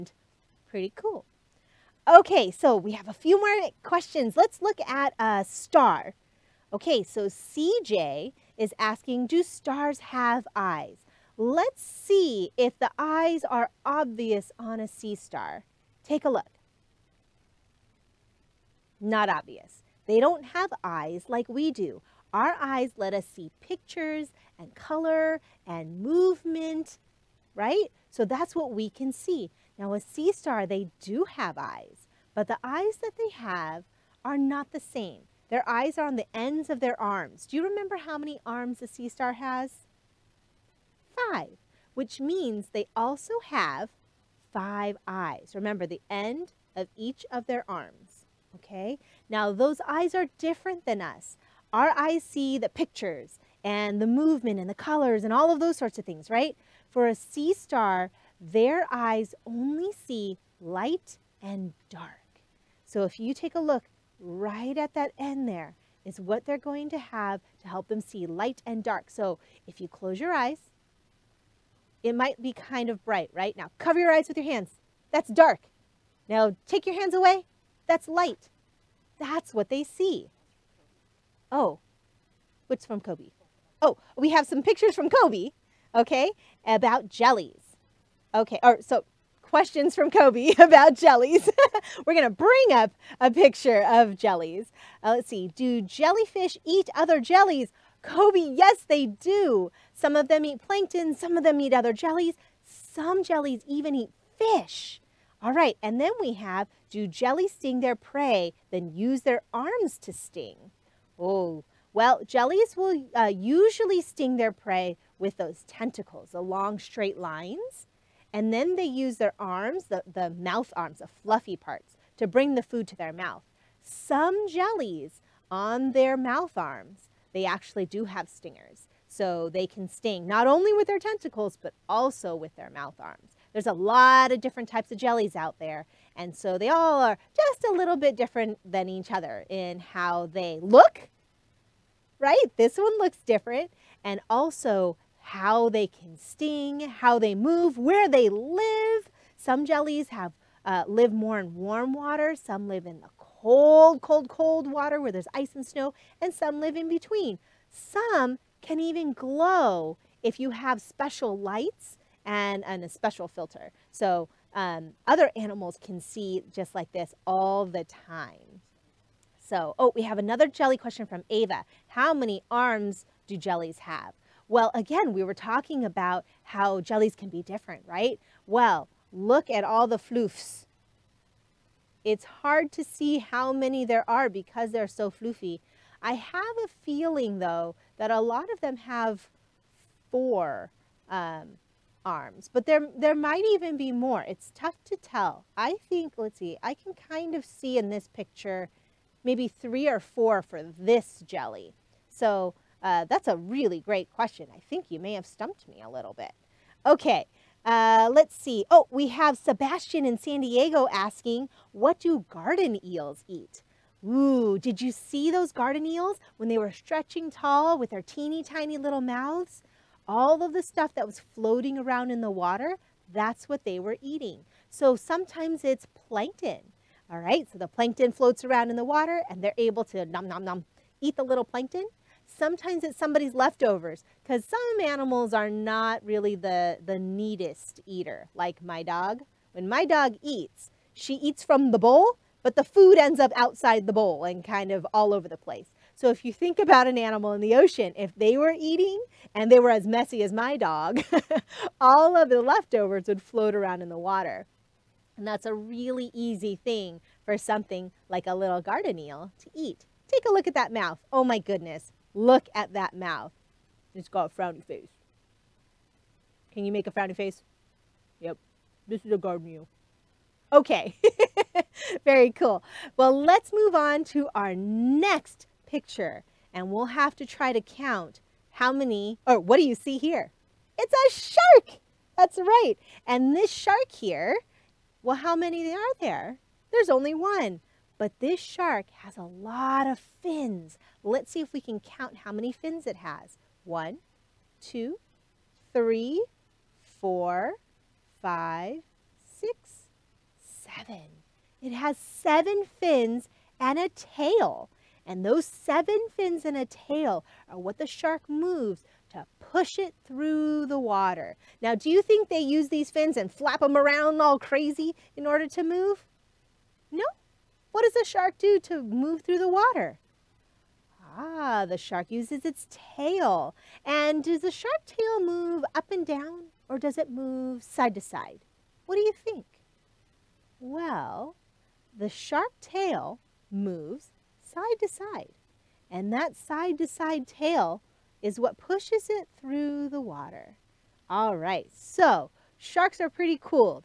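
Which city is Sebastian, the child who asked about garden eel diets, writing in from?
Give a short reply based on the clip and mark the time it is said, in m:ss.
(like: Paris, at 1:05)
San Diego, at 3:30.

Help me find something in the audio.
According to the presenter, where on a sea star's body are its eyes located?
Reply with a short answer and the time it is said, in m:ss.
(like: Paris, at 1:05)
Ends of their arms, at 0:36.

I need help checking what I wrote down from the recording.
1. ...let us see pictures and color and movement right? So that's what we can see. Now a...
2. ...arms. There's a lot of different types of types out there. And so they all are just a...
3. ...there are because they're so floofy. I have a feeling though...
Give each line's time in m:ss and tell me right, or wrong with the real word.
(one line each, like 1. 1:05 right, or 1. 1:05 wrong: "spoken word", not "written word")
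1. 0:22 right
2. 2:12 wrong: "jellies", not "types"
3. 3:03 right.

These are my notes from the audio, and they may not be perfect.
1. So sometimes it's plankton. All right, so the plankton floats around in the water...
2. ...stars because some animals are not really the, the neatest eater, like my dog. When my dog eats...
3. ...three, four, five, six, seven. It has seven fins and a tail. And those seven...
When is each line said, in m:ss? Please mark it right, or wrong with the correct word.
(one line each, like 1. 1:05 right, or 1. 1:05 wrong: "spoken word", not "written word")
1. 3:44 right
2. 3:53 wrong: "leftovers", not "stars"
3. 4:55 right.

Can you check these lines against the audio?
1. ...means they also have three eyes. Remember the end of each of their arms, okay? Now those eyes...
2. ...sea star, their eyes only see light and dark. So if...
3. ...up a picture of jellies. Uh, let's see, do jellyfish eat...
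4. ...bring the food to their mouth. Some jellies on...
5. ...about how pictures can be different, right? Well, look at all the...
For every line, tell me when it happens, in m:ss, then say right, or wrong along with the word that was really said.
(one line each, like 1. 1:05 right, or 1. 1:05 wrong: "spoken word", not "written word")
1. 0:42 wrong: "five", not "three"
2. 0:57 right
3. 1:32 right
4. 2:02 right
5. 2:55 wrong: "jellies", not "pictures".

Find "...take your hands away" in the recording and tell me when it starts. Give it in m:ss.
1:16.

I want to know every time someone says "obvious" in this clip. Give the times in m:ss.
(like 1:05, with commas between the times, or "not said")
0:13, 0:19.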